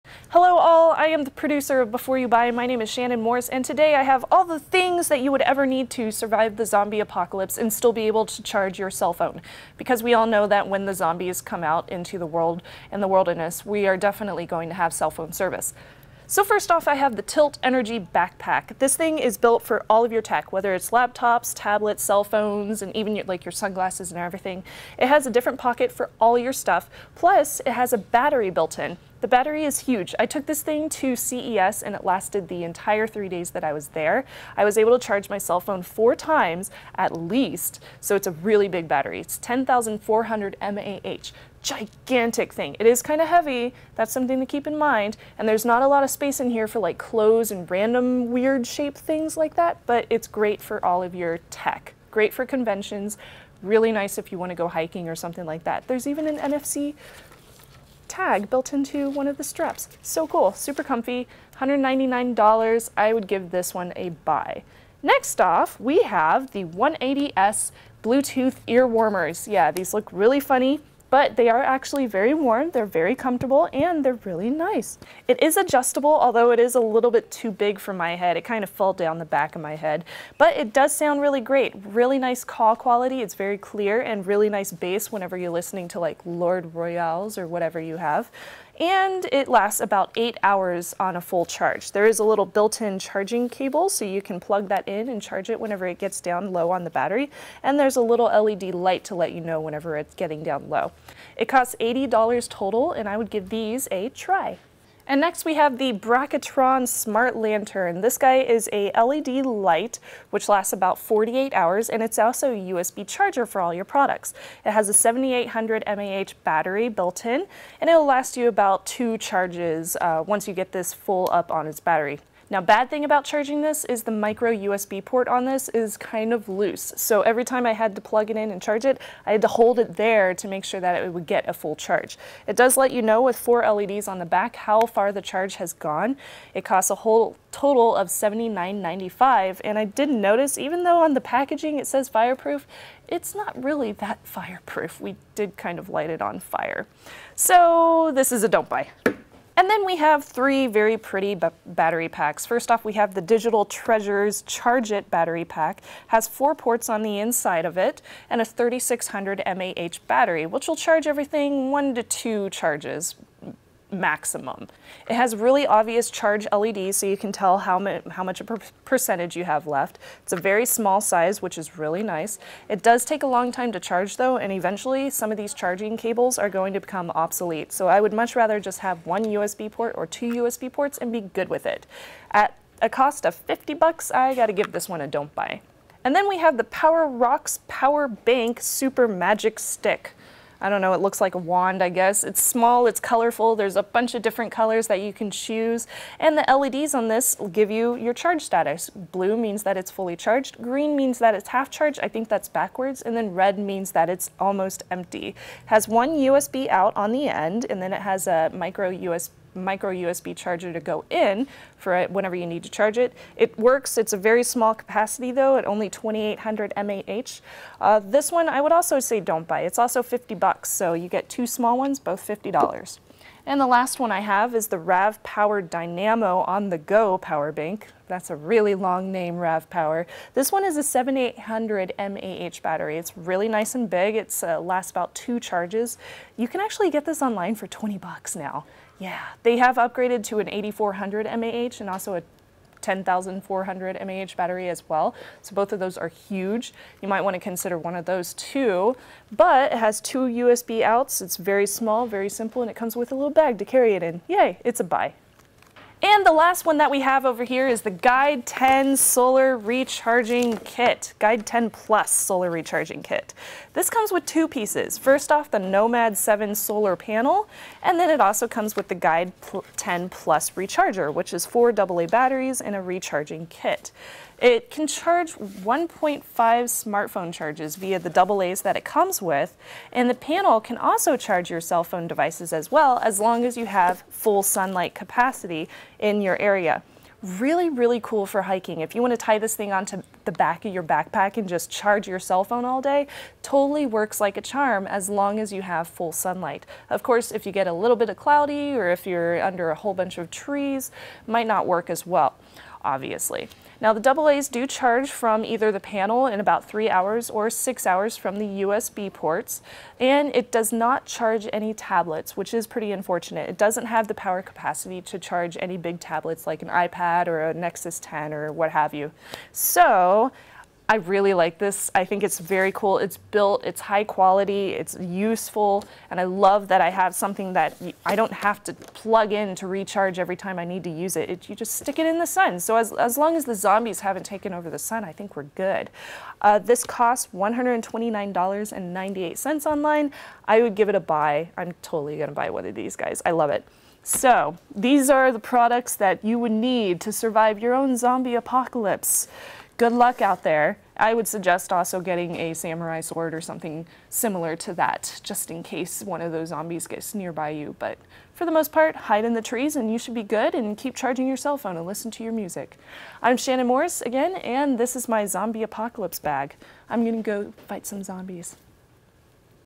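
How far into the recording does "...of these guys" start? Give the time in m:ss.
5:42.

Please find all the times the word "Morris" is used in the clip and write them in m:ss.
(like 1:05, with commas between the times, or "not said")
0:03, 6:03.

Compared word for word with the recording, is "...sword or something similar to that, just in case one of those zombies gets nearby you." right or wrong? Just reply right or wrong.
right.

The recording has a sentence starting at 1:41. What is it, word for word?
It costs $80 total, and I would give these a try.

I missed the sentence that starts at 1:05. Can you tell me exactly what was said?
Next off, we have the 180s Bluetooth ear warmers.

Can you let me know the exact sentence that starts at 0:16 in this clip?
So first off, I have the TYLT Energi Backpack.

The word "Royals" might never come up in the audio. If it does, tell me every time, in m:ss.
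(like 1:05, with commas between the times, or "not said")
1:26.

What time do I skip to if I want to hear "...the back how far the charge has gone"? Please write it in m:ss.
2:14.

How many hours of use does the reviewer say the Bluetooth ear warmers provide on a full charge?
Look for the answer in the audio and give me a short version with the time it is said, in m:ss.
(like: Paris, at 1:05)
8 hours, at 1:30.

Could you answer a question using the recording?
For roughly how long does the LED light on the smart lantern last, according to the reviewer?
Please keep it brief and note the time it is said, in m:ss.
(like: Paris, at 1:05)
48 hours, at 1:50.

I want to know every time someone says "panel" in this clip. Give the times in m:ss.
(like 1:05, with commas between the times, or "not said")
4:26, 4:40, 5:05.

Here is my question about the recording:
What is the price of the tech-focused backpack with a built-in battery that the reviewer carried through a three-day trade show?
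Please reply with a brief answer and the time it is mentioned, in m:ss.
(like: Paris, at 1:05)
$199, at 1:01.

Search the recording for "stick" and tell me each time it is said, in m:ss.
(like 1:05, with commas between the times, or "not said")
3:09, 5:31.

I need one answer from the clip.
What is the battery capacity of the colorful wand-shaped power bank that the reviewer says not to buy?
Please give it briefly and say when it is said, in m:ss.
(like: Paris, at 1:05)
2800 mAh, at 3:35.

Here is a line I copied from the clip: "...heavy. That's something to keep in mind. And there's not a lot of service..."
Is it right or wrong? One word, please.
wrong.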